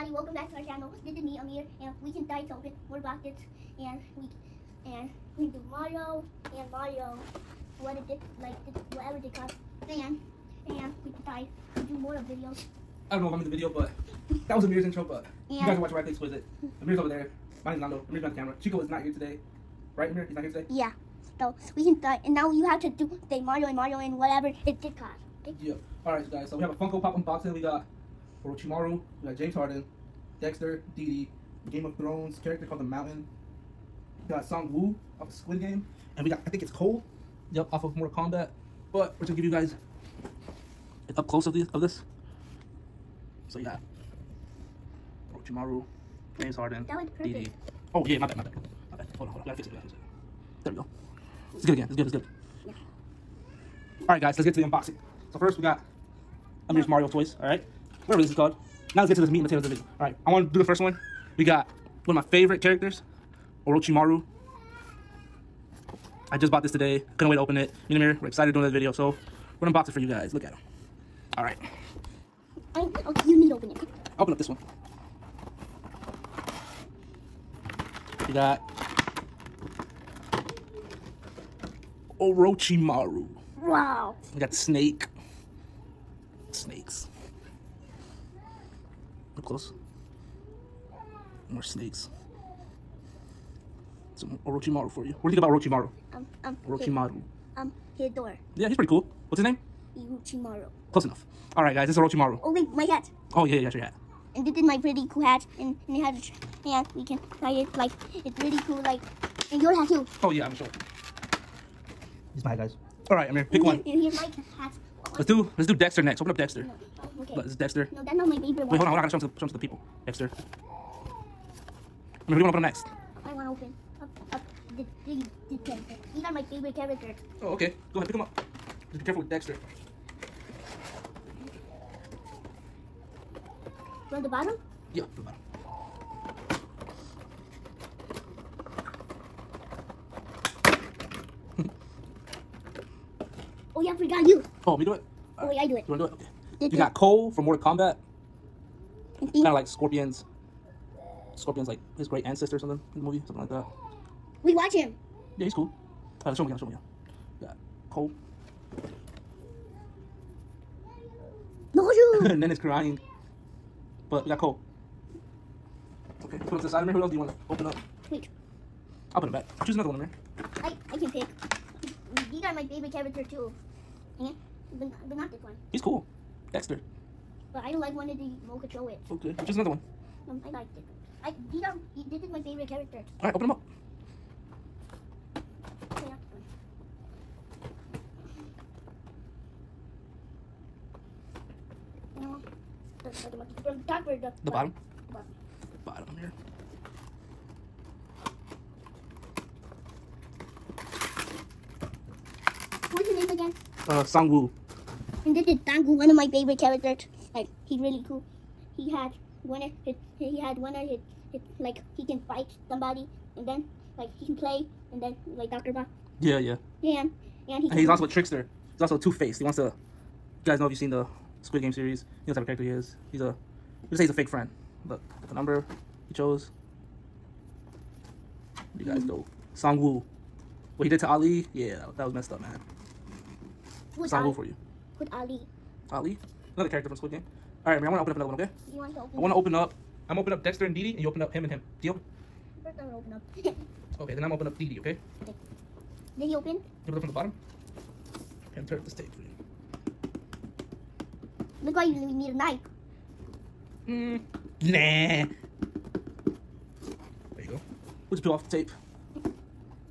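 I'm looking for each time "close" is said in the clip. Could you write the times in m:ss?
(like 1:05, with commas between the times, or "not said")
0:41, 1:29, 1:40.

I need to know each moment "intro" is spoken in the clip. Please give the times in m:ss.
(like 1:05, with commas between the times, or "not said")
0:14.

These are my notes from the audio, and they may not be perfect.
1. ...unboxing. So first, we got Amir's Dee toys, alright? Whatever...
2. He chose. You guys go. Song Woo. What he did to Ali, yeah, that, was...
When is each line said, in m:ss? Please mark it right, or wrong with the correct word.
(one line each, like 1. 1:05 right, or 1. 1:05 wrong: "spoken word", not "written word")
1. 0:54 wrong: "Mario", not "Dee"
2. 3:46 right.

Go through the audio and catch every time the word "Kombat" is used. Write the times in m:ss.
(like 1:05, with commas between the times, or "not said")
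0:38, 2:27.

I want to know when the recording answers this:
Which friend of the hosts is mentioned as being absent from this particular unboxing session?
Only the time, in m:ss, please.
0:18.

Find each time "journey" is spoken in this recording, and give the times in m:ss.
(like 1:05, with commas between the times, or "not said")
not said.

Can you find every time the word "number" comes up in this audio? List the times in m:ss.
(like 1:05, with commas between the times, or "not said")
3:45.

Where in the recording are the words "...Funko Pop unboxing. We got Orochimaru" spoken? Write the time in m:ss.
0:26.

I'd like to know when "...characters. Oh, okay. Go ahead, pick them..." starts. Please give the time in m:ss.
2:06.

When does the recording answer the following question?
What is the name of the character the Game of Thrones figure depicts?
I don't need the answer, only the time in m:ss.
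0:32.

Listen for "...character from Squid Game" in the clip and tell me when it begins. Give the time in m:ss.
3:56.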